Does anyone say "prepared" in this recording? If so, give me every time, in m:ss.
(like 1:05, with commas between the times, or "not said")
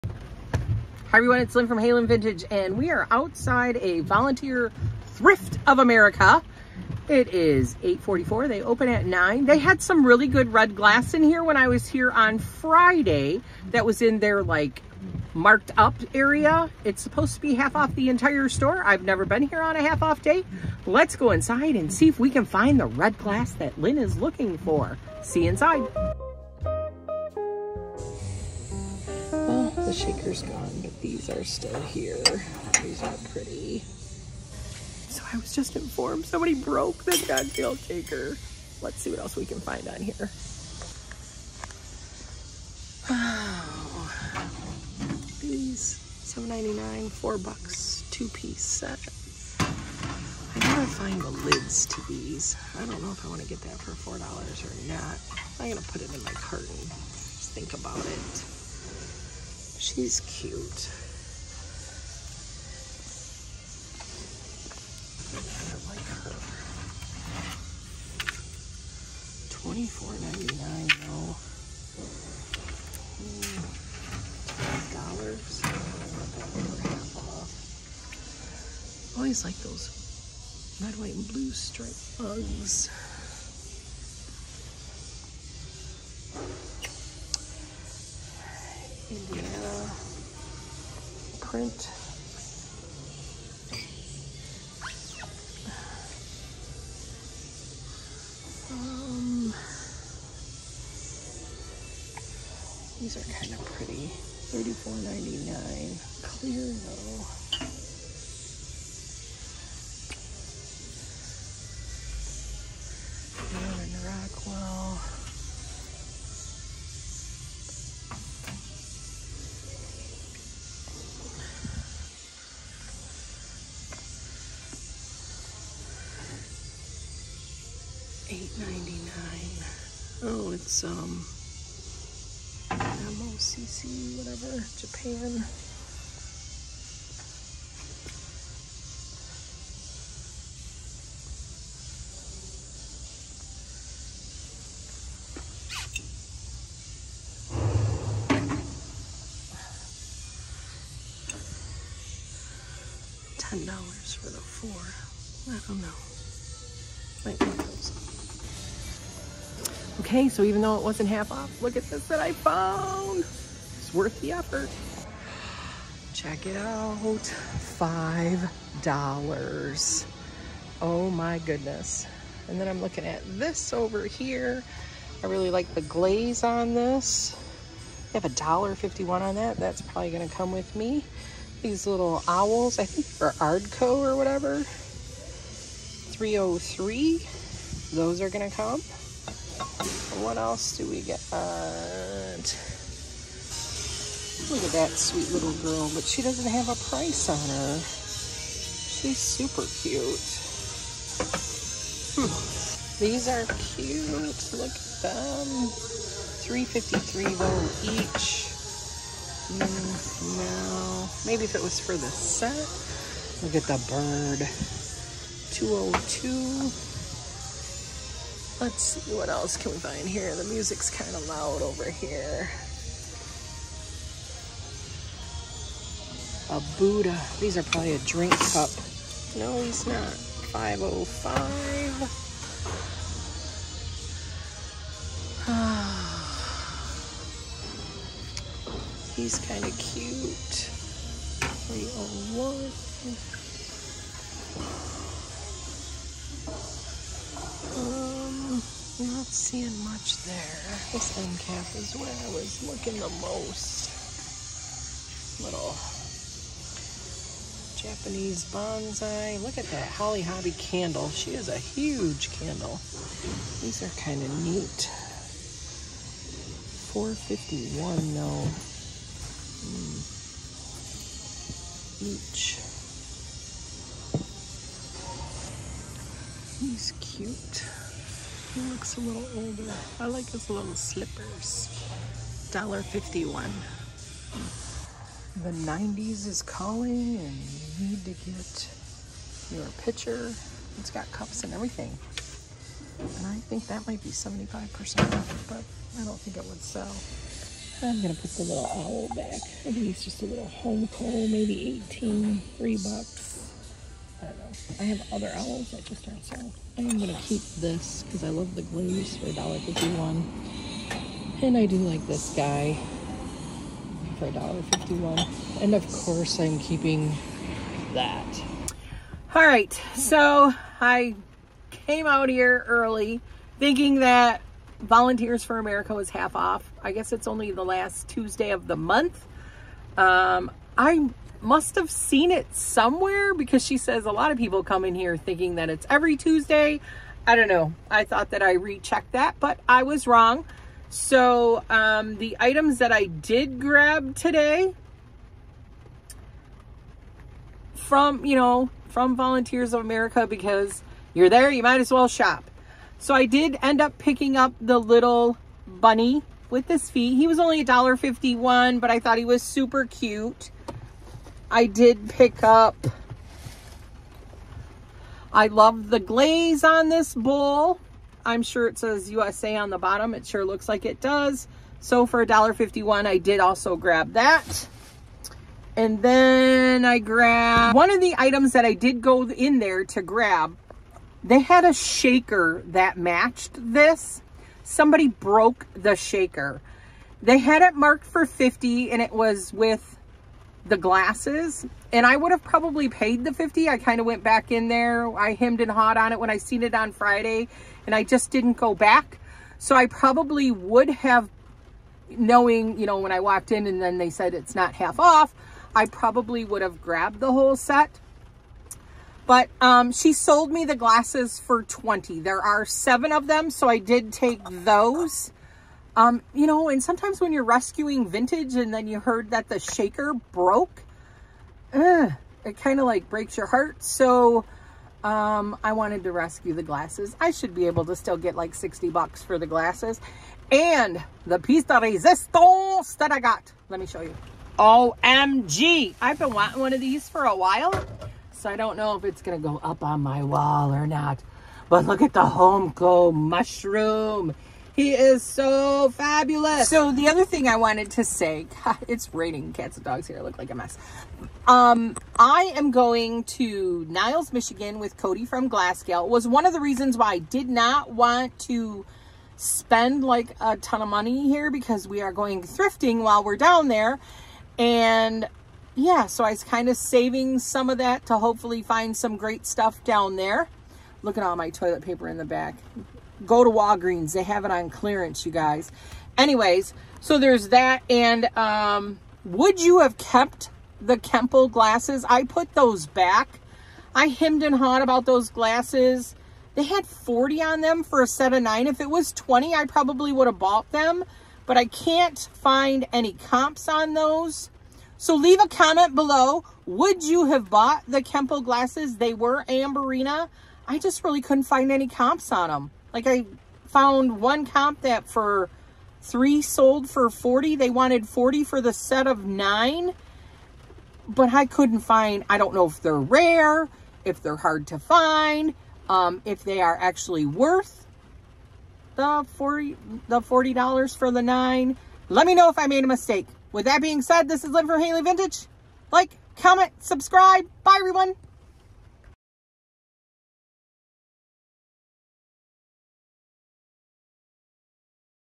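not said.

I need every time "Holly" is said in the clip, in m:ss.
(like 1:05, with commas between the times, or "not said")
4:19.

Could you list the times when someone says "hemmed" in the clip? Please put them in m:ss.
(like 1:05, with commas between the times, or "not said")
6:35, 8:04.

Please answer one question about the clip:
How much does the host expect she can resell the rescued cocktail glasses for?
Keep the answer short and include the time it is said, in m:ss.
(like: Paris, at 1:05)
$60, at 7:08.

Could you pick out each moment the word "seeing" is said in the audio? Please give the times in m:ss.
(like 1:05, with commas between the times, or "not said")
4:09.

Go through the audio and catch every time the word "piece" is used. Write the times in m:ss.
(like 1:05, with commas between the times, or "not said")
0:48, 7:11.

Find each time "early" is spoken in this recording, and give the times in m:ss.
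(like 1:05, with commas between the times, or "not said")
5:22.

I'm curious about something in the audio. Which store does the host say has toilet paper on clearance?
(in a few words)
Walgreens.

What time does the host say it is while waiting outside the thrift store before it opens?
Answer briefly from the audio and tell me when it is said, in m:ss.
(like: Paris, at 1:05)
8:44, at 0:07.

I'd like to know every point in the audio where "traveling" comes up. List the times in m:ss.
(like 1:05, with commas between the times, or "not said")
not said.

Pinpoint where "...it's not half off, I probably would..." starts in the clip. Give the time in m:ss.
6:44.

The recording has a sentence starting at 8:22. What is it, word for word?
Like I found one comp that for three sold for 40.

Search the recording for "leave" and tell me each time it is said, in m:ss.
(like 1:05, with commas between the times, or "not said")
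8:15.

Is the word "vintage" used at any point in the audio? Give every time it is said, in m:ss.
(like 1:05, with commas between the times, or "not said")
0:02, 6:58, 8:45.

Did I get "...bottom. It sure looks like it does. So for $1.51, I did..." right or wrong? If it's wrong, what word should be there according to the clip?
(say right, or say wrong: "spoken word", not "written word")
right.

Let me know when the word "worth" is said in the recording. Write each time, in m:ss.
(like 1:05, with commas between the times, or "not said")
2:43, 8:37.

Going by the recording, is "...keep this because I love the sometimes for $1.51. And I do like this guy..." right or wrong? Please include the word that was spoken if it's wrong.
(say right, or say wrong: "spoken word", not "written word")
wrong: "glues", not "sometimes".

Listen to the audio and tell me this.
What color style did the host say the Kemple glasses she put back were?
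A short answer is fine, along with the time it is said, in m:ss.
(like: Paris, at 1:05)
Amberina, at 8:19.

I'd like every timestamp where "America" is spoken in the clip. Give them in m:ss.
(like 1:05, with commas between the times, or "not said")
0:05, 5:25, 5:49.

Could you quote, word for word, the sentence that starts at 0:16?
It's supposed to be half off the entire store.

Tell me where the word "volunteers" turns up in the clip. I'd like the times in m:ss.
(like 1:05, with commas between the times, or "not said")
0:03, 5:24, 5:49.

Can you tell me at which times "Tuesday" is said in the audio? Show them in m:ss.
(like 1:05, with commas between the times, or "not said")
5:28, 5:36.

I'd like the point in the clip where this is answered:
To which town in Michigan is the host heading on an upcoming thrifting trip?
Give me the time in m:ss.
7:33.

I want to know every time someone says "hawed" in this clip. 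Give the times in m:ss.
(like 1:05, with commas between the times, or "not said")
6:35, 8:04.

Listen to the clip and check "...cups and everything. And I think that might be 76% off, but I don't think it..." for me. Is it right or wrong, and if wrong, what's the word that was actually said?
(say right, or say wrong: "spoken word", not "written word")
wrong: "75", not "76".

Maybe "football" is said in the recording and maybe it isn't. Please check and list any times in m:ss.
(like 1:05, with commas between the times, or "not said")
not said.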